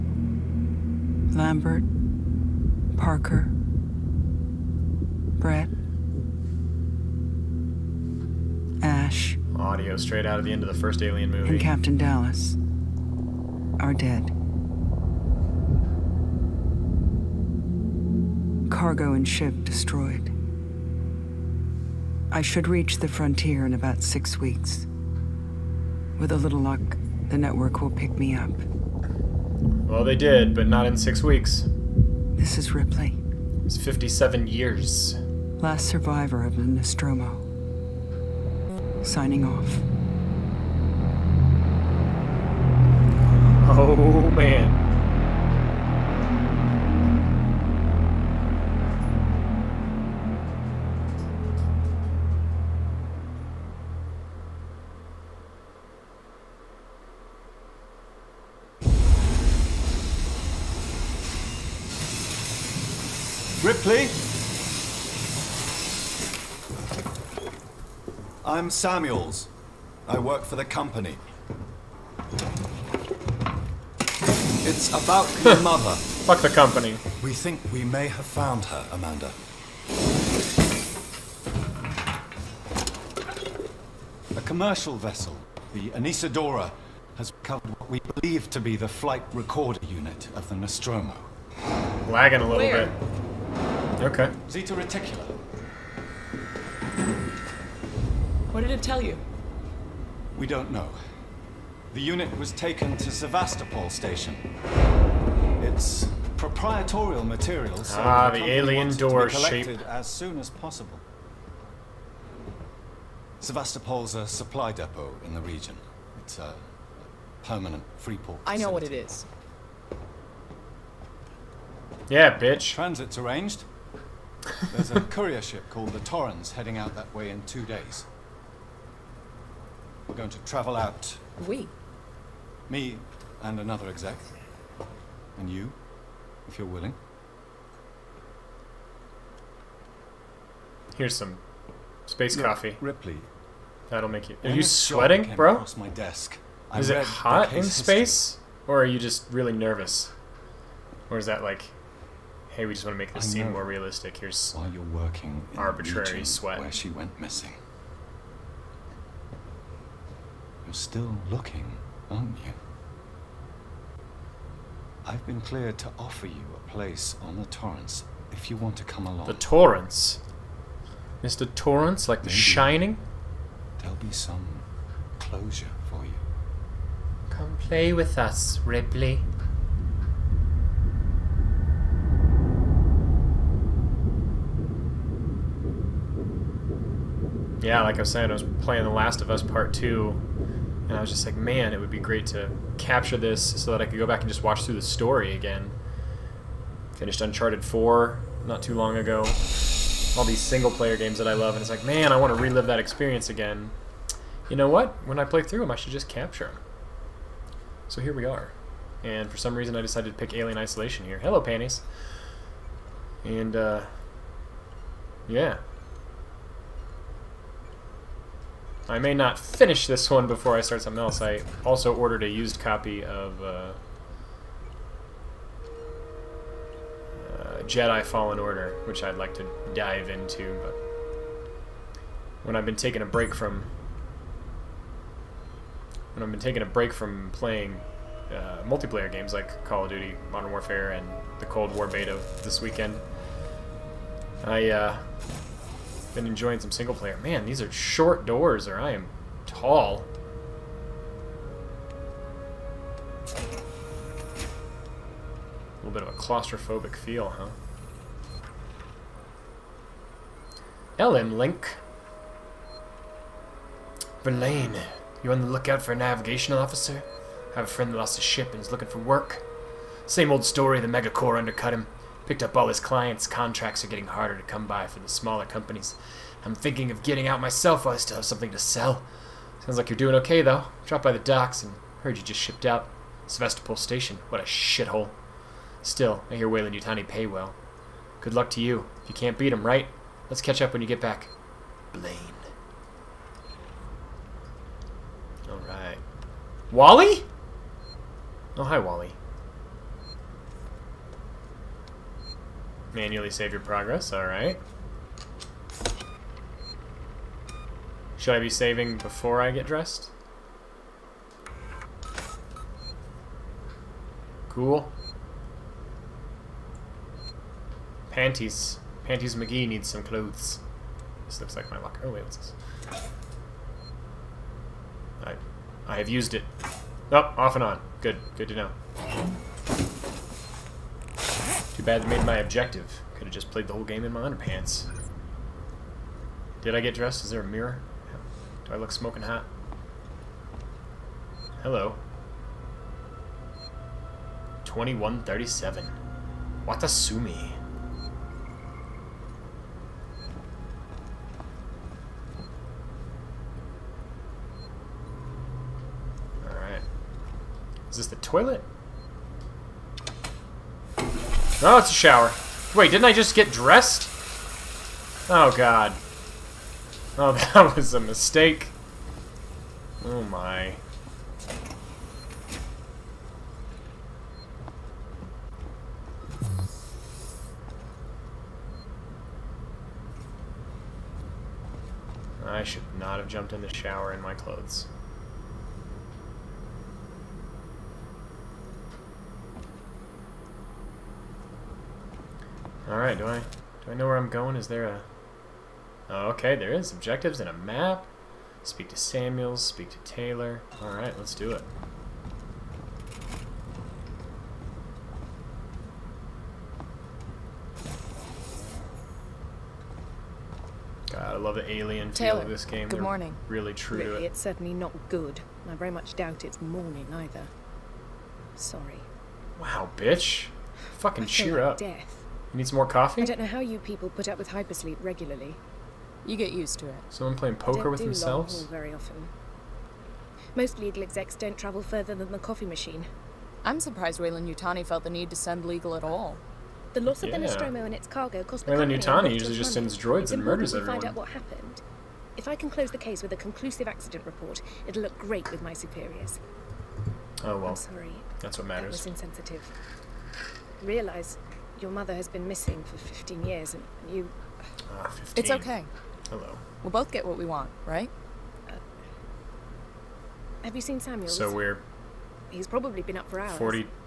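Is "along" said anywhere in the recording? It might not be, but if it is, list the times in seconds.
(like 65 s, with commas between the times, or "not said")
169 s.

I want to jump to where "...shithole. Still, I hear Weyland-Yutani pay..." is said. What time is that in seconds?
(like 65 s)
284 s.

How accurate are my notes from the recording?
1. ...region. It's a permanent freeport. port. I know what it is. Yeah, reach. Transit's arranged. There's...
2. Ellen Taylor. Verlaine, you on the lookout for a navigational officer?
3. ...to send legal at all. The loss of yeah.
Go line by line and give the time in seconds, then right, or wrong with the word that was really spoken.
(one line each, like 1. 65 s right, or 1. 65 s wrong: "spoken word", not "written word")
1. 115 s wrong: "bitch", not "reach"
2. 260 s wrong: "Link", not "Taylor"
3. 435 s right.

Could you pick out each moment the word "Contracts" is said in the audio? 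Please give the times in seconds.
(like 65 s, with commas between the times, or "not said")
273 s.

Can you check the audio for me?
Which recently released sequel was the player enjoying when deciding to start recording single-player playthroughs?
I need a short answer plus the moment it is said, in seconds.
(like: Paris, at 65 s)
The Last of Us Part 2, at 188 s.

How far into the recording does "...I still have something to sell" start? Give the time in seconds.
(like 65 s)
277 s.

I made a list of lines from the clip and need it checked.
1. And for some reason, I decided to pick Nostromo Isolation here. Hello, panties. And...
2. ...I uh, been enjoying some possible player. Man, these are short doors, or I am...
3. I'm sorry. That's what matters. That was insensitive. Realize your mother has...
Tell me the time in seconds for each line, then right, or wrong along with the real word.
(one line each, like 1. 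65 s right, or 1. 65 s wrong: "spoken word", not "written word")
1. 209 s wrong: "Alien", not "Nostromo"
2. 244 s wrong: "single", not "possible"
3. 447 s right.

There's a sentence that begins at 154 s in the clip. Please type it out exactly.
Here's while you're working arbitrary sweat where she went missing.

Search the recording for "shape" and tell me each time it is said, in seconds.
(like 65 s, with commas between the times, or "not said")
109 s.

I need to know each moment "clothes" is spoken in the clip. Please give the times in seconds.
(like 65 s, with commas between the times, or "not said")
320 s, 384 s.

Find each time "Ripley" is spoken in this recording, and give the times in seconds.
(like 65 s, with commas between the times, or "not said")
32 s, 142 s, 178 s.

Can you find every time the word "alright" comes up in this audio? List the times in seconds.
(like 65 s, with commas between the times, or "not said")
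295 s, 304 s, 356 s, 392 s, 400 s.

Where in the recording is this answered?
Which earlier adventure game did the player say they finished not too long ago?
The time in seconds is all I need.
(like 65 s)
197 s.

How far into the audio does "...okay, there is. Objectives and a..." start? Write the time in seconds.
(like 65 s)
396 s.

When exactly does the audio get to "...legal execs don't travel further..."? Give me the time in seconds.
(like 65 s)
430 s.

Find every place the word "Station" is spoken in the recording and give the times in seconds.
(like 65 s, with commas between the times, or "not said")
103 s, 283 s.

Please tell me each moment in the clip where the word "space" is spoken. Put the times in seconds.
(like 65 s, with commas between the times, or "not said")
142 s, 147 s.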